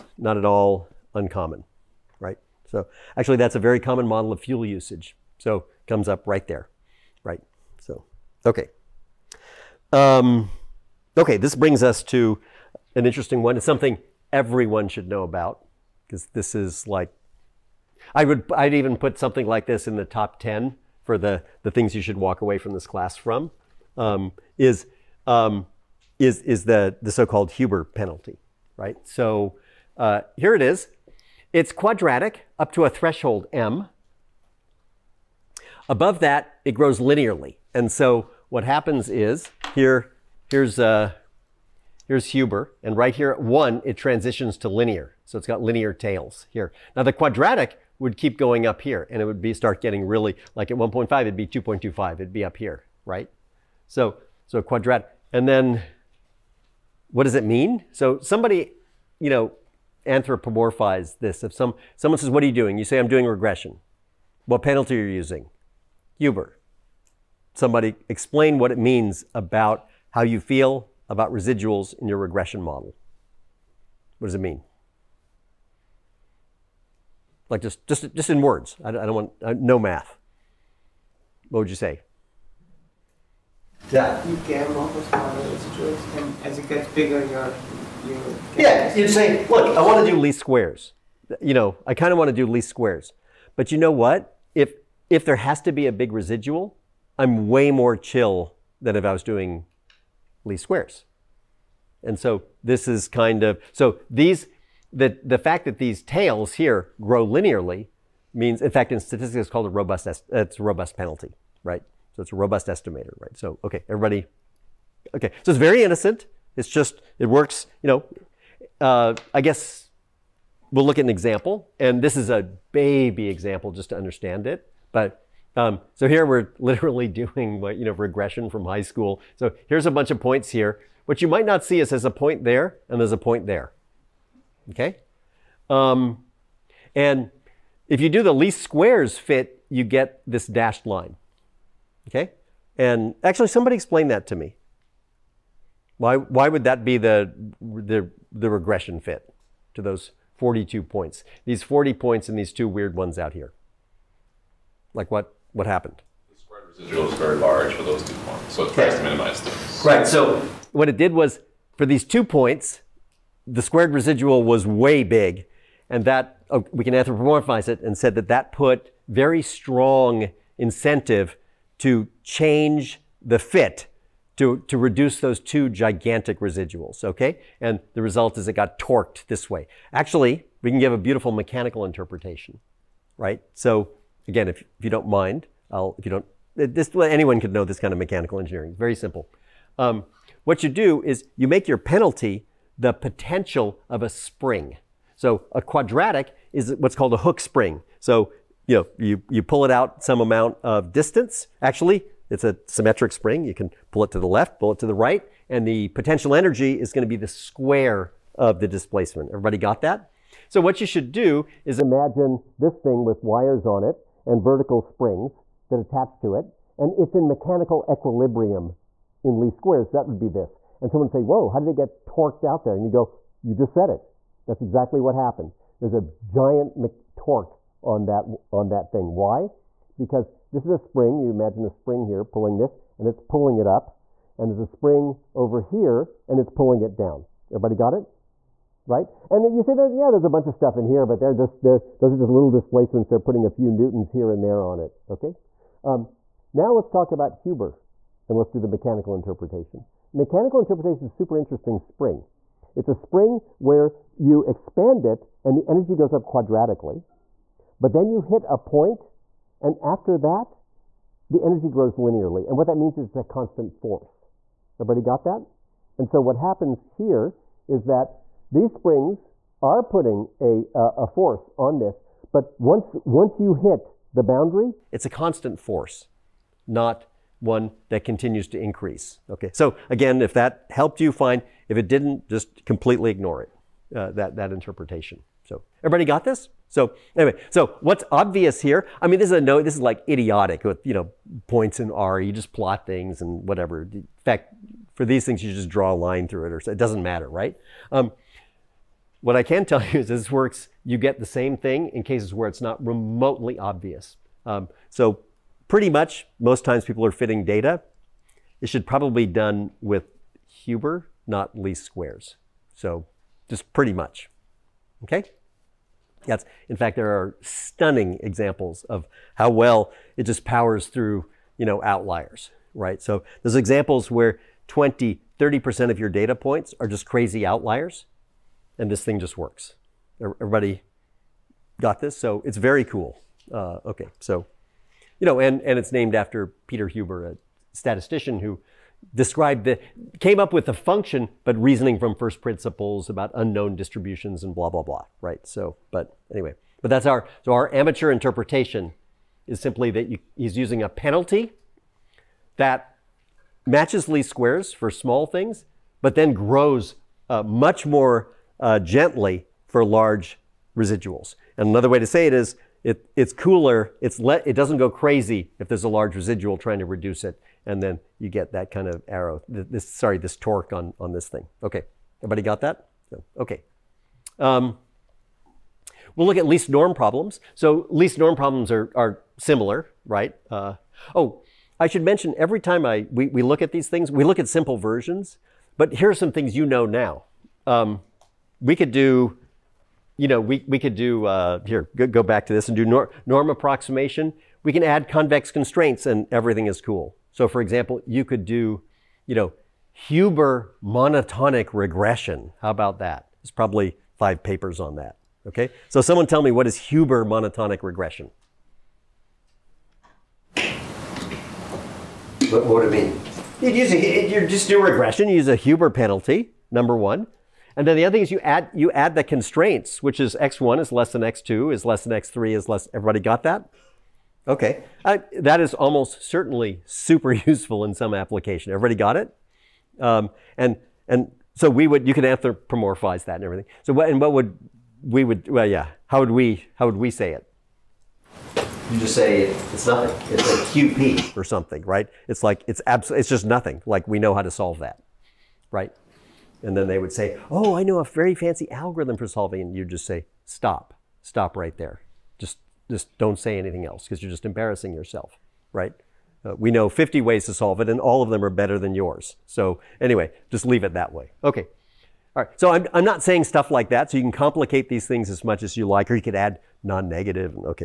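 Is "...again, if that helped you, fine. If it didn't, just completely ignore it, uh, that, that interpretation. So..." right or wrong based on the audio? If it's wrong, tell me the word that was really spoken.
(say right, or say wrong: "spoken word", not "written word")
right.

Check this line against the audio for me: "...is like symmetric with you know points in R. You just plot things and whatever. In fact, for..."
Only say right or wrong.
wrong.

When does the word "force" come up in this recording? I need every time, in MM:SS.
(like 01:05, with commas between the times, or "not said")
04:23, 04:31, 04:35.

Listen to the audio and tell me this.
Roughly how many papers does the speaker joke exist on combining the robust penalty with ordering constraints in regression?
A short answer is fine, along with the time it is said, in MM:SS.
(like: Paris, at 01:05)
5, at 06:44.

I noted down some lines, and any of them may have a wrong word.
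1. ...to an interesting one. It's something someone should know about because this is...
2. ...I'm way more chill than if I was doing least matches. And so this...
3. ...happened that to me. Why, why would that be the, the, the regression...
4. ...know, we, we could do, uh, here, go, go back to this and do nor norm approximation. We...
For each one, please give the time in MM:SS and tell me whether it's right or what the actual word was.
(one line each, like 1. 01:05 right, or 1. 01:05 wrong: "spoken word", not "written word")
1. 00:12 wrong: "everyone", not "someone"
2. 01:37 wrong: "squares", not "matches"
3. 02:23 wrong: "explained", not "happened"
4. 06:30 right.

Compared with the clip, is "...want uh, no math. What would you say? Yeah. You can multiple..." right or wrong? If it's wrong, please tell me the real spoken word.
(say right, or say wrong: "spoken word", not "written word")
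right.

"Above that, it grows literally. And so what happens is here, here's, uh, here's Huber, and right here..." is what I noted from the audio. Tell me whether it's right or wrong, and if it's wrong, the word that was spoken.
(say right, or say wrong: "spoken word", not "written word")
wrong: "linearly", not "literally".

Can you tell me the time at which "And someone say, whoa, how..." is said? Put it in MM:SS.
03:40.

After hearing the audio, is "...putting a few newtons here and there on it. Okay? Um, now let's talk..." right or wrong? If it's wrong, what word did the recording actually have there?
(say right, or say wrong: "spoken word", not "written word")
right.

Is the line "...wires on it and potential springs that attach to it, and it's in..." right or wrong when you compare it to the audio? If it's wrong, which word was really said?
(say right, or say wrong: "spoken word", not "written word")
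wrong: "vertical", not "potential".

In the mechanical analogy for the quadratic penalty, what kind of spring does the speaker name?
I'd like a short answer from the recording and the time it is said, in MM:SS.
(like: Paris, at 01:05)
Hooke spring, at 03:17.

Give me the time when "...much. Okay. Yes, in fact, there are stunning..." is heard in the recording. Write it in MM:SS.
05:13.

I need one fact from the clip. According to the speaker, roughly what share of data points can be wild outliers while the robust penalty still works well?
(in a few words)
20-30%.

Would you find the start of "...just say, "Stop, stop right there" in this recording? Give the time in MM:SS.
07:29.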